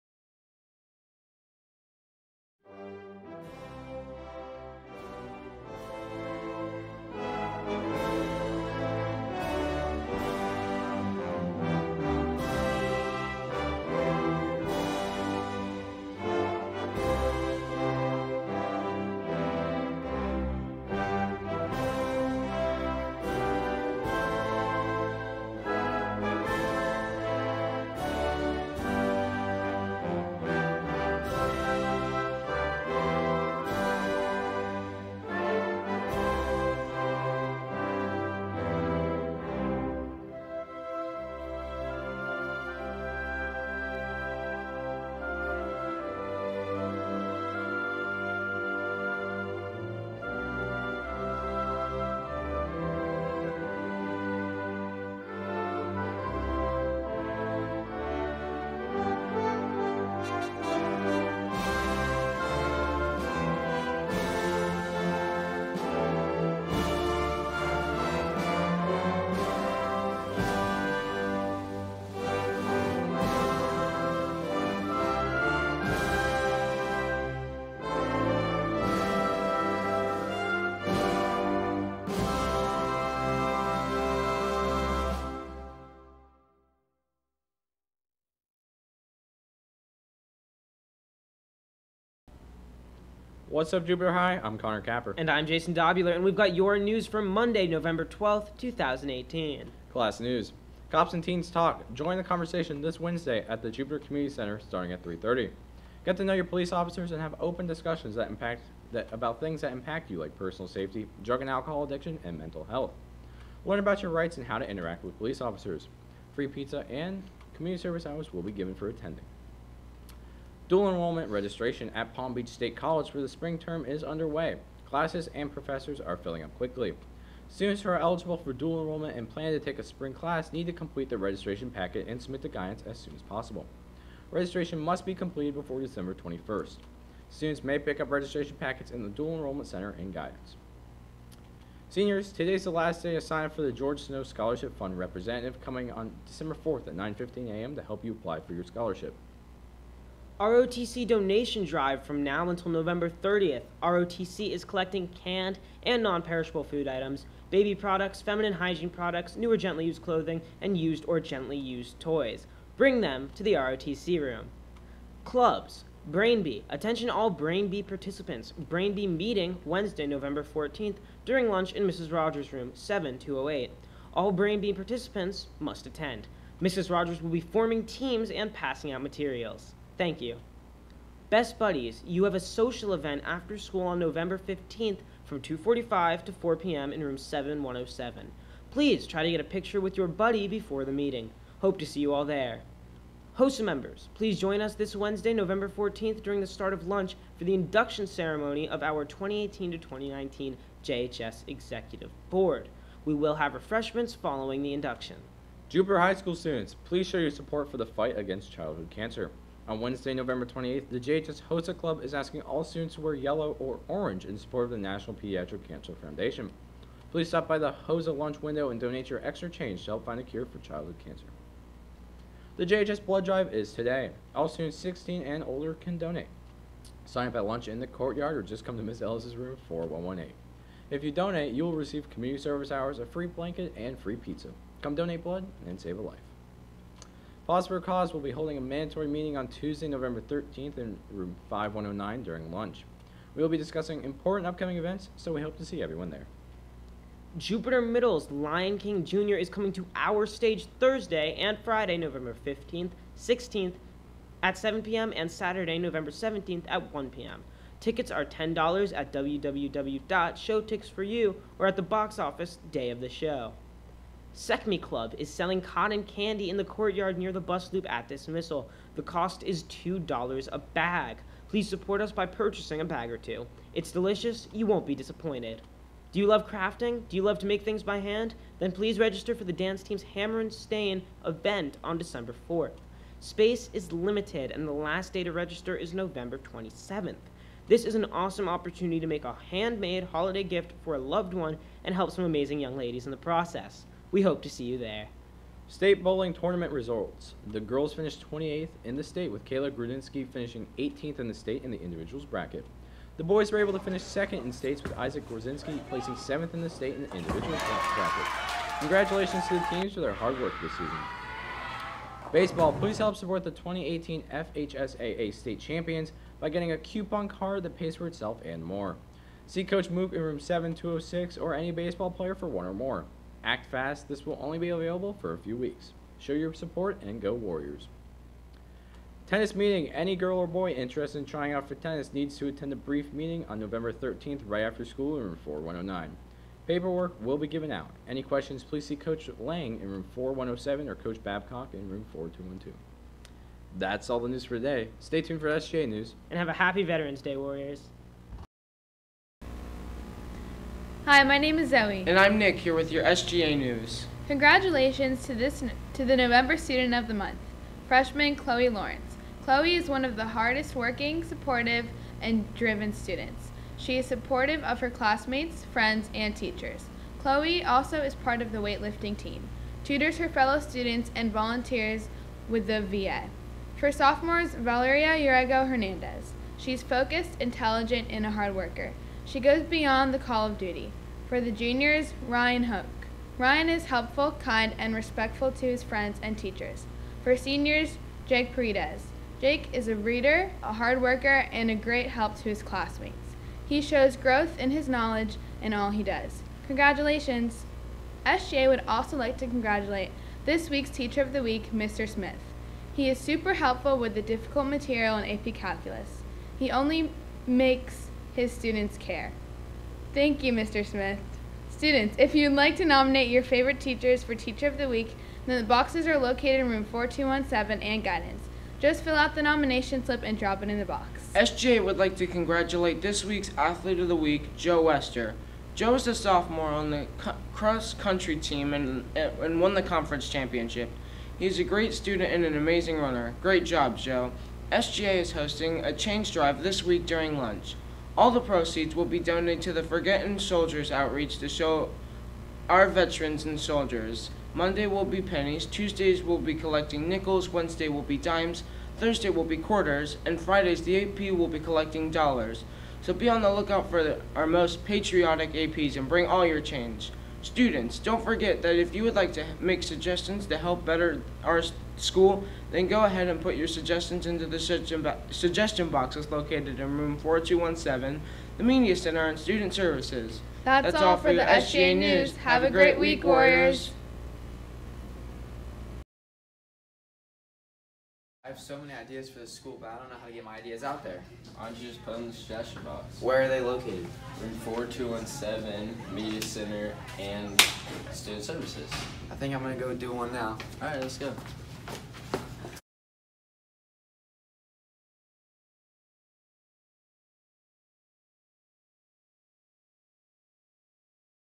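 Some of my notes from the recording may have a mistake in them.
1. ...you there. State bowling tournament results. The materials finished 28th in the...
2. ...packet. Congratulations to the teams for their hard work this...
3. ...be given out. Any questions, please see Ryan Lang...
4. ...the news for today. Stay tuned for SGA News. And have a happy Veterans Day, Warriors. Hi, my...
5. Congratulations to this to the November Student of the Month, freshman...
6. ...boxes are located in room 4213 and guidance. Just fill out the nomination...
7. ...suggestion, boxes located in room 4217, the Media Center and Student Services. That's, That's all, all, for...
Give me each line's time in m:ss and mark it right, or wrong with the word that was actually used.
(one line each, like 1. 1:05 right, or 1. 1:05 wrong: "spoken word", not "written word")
1. 4:54 wrong: "girls", not "materials"
2. 5:07 wrong: "bracket", not "packet"
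3. 5:37 wrong: "Coach", not "Ryan"
4. 5:44 right
5. 5:54 right
6. 6:55 wrong: "4217", not "4213"
7. 7:45 right.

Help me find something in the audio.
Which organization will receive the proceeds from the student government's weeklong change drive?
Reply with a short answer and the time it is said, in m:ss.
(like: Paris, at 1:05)
Forgotten Soldiers outreach, at 7:19.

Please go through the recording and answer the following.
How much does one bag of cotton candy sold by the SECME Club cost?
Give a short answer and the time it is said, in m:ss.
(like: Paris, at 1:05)
$2, at 4:29.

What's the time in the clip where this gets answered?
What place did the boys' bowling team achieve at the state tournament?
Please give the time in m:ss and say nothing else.
5:04.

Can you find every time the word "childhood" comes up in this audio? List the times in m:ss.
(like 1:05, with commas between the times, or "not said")
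3:28, 3:40.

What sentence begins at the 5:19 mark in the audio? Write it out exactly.
See Coach Mook in room 7206 or any baseball player for one or more.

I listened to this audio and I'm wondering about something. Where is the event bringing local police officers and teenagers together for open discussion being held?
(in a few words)
Jupiter Community Center.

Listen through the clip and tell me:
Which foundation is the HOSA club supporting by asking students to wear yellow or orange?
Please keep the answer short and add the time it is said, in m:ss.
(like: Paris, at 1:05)
National Pediatric Cancer Foundation, at 3:34.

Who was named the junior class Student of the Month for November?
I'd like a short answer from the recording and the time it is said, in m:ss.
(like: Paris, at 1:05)
Ryan Hook, at 6:22.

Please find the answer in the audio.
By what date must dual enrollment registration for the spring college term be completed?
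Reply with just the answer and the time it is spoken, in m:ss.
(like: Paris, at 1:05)
December 21st, at 2:15.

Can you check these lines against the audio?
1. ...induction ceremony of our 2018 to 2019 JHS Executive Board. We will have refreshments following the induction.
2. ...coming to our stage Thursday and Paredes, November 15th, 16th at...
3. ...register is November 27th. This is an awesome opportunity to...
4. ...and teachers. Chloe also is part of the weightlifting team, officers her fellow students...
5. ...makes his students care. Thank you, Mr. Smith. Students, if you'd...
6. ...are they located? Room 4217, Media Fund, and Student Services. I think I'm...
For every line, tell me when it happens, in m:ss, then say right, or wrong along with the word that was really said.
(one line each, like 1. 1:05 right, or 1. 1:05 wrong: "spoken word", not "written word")
1. 3:17 right
2. 4:09 wrong: "Friday", not "Paredes"
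3. 4:45 right
4. 6:06 wrong: "tutors", not "officers"
5. 6:47 right
6. 8:03 wrong: "Center", not "Fund".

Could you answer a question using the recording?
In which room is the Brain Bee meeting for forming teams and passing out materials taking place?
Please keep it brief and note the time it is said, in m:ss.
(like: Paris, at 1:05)
7208, at 2:52.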